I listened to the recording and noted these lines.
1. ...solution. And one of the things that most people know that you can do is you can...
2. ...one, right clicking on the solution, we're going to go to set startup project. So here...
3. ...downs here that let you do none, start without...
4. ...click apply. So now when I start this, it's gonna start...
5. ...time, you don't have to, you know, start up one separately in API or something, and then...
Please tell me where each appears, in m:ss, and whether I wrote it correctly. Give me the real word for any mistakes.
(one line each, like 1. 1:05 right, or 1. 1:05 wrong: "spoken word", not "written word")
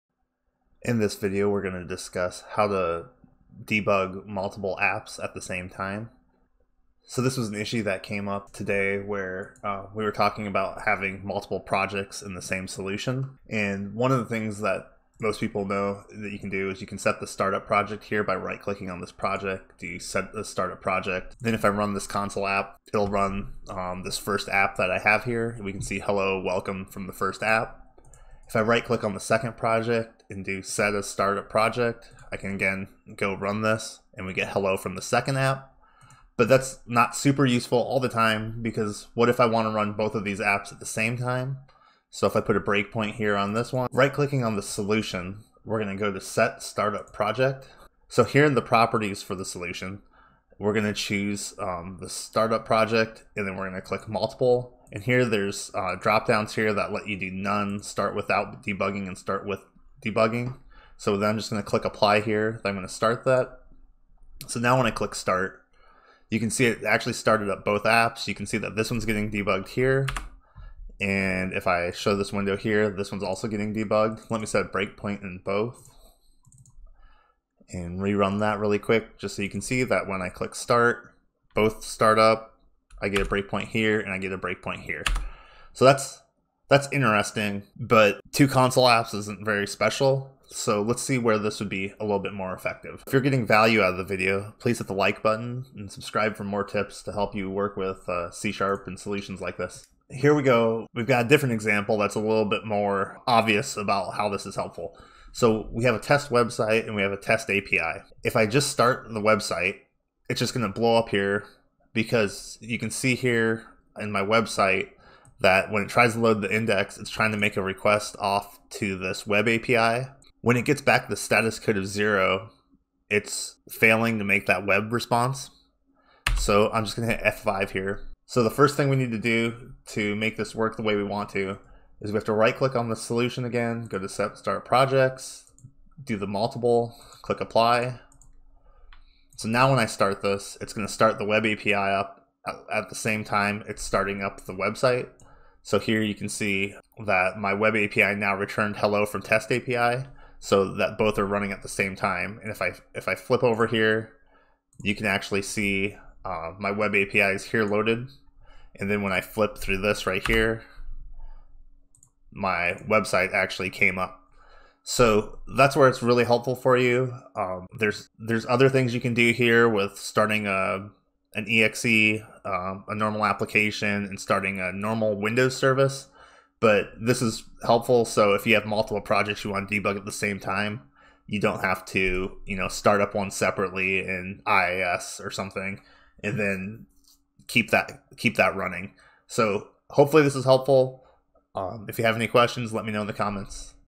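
1. 0:12 right
2. 0:43 right
3. 0:56 right
4. 2:17 right
5. 3:00 wrong: "IIS", not "API".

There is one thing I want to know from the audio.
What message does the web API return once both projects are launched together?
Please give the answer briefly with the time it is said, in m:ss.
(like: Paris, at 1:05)
Hello from test API, at 2:28.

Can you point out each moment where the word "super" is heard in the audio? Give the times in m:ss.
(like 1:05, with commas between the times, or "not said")
0:37.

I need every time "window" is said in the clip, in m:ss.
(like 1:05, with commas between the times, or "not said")
1:12, 2:55.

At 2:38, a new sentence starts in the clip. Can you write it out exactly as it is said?
And then when I flip through this right here, my website actually came up.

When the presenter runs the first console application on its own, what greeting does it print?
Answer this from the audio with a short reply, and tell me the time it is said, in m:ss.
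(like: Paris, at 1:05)
Hello, welcome from the first app, at 0:25.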